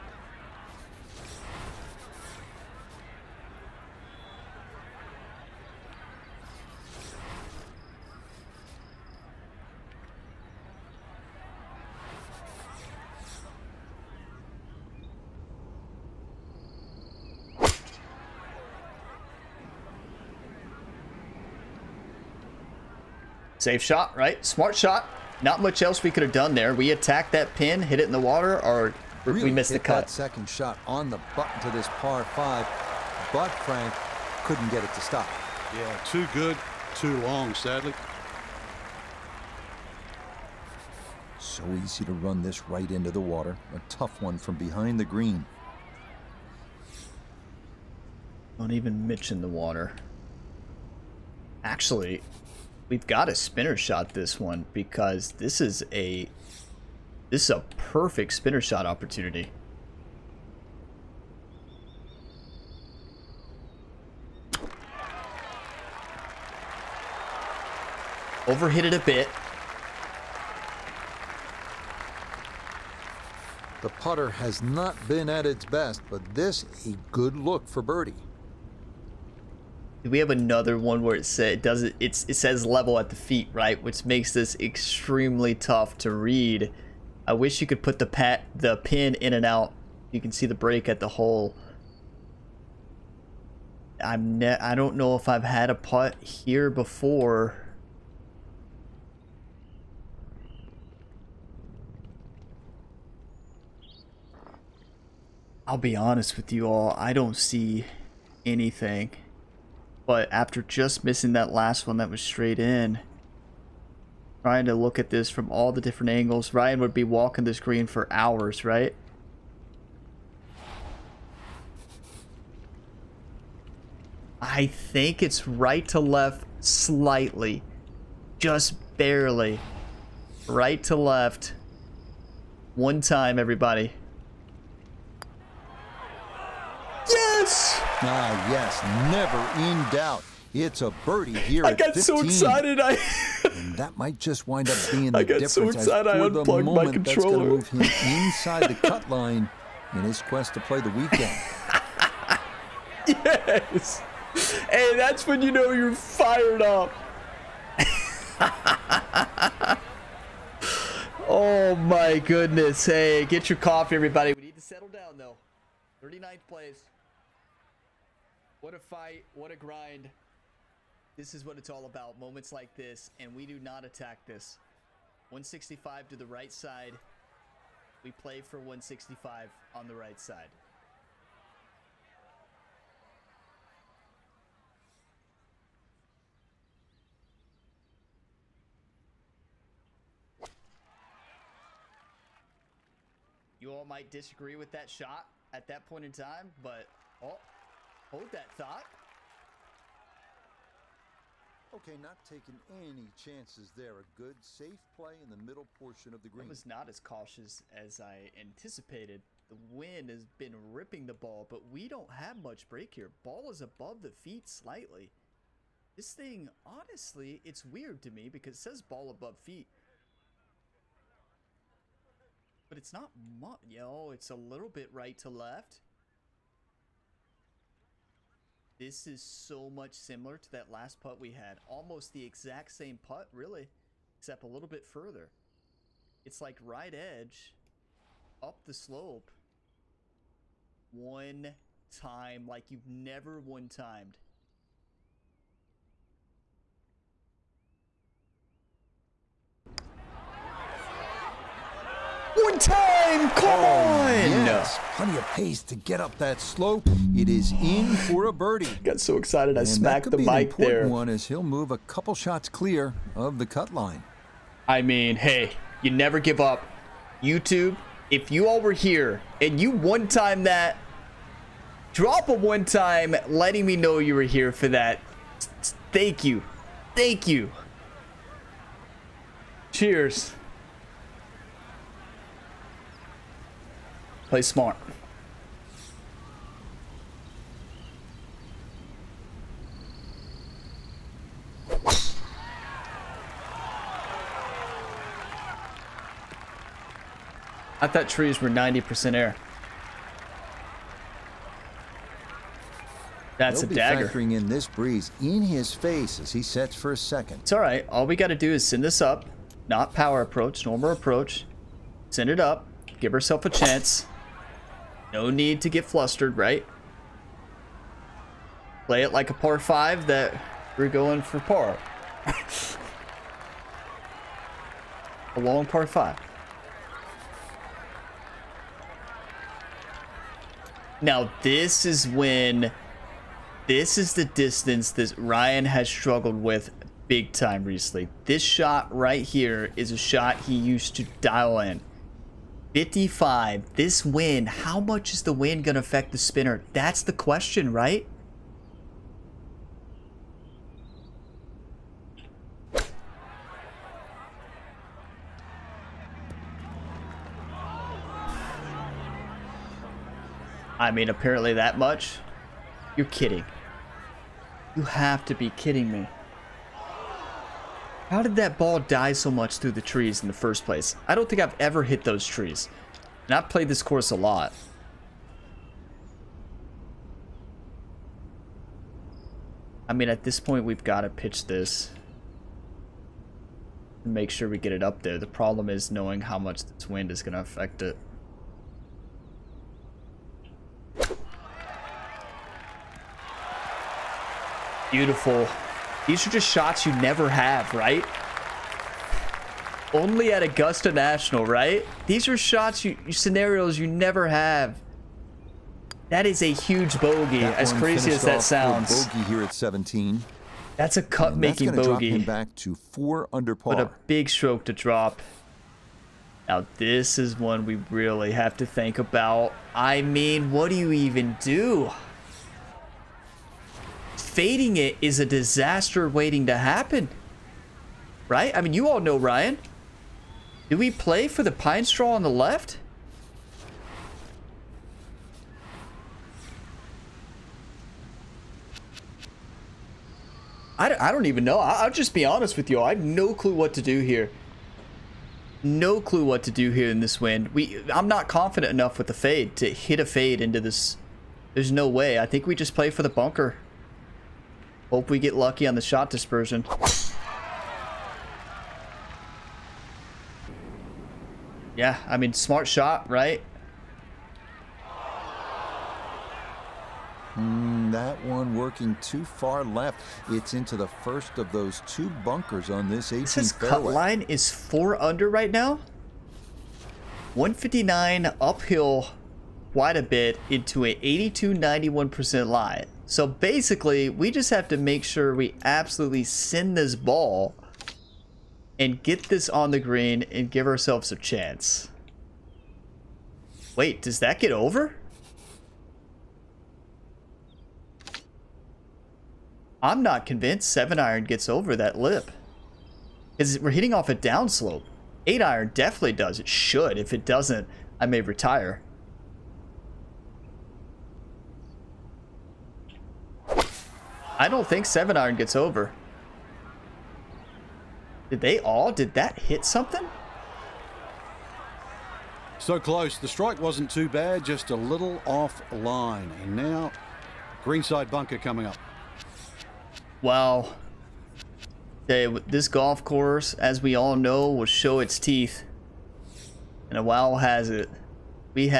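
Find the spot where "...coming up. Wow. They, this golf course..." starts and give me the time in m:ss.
8:48.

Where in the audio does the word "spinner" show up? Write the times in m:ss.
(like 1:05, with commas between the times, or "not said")
0:53, 0:58, 5:46.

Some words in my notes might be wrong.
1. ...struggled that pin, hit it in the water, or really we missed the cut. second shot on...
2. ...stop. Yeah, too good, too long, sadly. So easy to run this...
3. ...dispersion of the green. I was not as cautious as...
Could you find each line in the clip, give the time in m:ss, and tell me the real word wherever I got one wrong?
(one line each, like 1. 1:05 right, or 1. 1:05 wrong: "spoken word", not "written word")
1. 0:26 wrong: "attacked", not "struggled"
2. 0:35 right
3. 3:25 wrong: "portion", not "dispersion".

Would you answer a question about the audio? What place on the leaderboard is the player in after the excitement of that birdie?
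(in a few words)
39th place.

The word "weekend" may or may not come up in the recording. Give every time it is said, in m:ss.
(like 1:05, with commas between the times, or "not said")
2:30.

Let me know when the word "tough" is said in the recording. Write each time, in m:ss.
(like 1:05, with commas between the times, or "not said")
0:43, 1:25.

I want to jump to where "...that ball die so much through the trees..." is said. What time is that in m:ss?
6:08.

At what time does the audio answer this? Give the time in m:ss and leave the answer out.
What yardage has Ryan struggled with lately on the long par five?
5:42.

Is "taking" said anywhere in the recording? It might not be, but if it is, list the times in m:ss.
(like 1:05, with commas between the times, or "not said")
3:22.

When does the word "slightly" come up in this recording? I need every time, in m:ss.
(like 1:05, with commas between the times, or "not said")
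2:06, 3:34.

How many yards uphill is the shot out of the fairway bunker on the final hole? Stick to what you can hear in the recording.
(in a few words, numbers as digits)
159.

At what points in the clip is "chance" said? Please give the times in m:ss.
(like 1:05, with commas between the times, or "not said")
3:23, 5:13, 8:11.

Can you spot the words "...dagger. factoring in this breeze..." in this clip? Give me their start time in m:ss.
5:03.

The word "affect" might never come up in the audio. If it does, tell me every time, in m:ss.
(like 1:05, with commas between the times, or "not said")
5:45, 6:27.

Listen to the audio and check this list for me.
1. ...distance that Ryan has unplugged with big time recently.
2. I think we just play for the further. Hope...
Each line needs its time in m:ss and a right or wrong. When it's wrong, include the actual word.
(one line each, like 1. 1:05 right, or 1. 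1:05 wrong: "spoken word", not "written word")
1. 5:34 wrong: "struggled", not "unplugged"
2. 7:32 wrong: "bunker", not "further".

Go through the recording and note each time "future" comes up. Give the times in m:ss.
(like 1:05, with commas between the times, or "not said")
not said.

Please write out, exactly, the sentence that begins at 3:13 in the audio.
You all might disagree with that shot at that point in time, but oh, Hold that thought.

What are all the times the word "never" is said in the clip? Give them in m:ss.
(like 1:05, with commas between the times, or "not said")
2:19, 4:02, 4:25, 6:36, 6:43.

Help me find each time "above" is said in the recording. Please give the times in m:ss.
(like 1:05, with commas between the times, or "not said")
3:33, 3:39.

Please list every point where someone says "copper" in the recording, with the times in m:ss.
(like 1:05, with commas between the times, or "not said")
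not said.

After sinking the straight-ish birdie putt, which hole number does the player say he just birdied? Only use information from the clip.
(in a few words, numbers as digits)
15.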